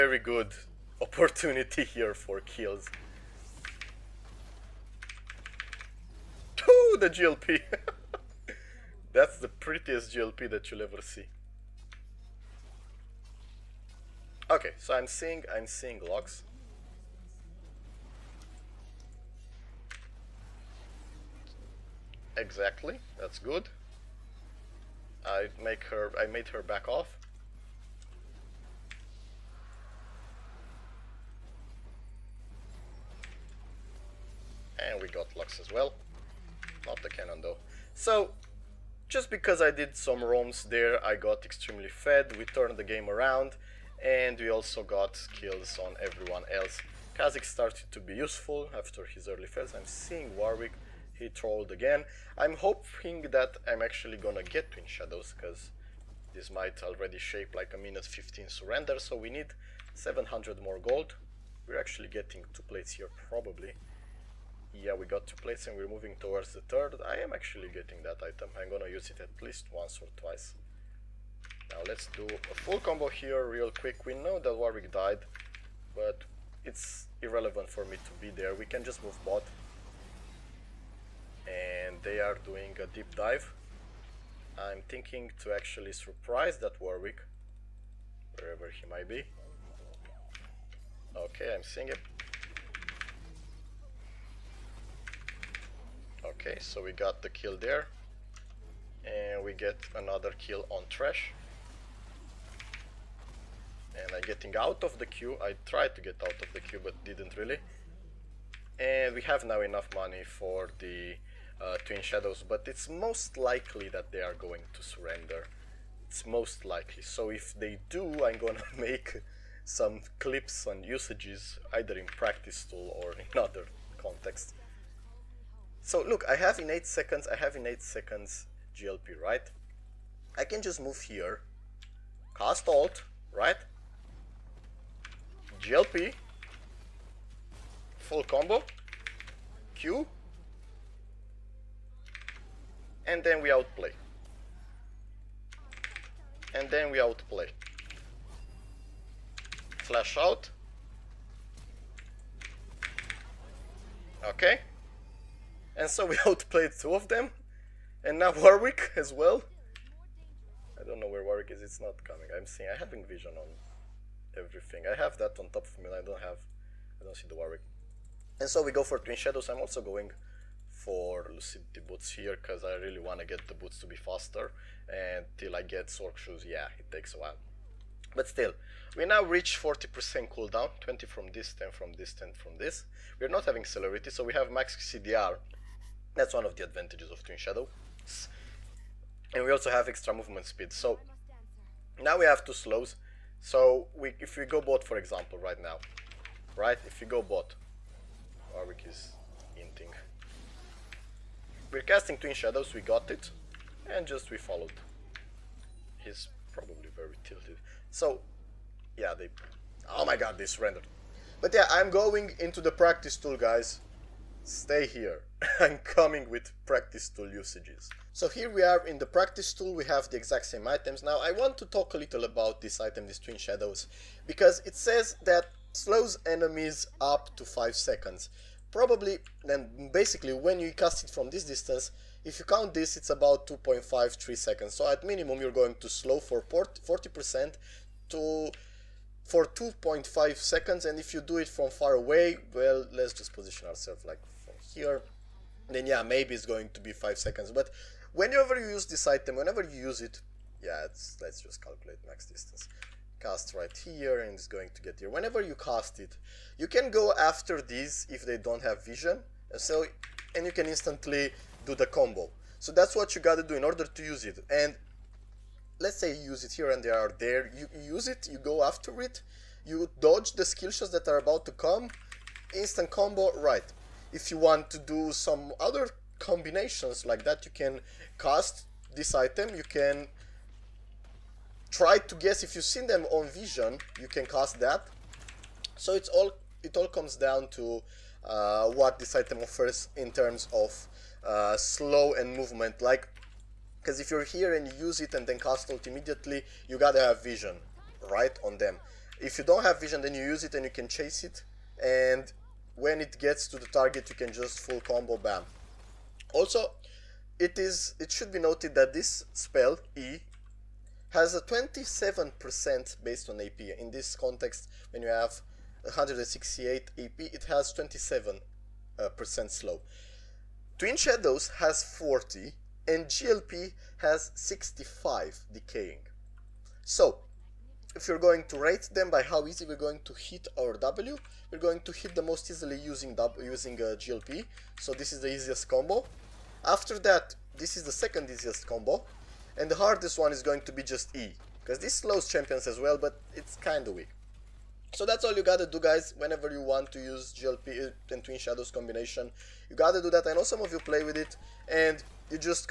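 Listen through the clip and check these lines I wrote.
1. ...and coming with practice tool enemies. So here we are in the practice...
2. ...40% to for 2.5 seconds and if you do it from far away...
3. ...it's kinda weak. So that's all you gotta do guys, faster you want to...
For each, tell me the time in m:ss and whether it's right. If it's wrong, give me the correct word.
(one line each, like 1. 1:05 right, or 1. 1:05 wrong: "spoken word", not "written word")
1. 3:35 wrong: "usages", not "enemies"
2. 3:56 right
3. 5:43 wrong: "whenever", not "faster".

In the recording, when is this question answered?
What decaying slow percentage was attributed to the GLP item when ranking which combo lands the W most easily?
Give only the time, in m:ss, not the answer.
5:24.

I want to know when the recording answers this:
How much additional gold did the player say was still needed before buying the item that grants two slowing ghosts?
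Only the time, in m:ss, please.
0:59.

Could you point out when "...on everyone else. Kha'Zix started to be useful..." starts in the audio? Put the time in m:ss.
0:45.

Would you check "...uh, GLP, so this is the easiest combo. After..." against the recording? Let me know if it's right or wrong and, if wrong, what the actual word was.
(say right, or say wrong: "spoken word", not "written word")
right.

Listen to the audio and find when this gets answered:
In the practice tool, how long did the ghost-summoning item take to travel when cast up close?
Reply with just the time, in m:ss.
3:53.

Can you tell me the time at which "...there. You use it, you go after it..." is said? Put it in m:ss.
4:27.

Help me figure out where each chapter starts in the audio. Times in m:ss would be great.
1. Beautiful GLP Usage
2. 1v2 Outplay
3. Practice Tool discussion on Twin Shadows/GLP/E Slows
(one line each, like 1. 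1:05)
1. 0:10
2. 2:20
3. 3:30.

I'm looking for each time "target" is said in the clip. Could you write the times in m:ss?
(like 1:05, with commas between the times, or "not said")
5:03.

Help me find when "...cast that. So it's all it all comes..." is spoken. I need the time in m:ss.
4:44.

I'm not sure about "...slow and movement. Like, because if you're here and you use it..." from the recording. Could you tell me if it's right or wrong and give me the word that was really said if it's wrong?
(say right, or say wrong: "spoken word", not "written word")
right.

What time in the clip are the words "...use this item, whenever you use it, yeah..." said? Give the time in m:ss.
4:08.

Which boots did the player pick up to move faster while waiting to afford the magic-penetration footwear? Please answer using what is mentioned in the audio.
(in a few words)
Lucidity Boots.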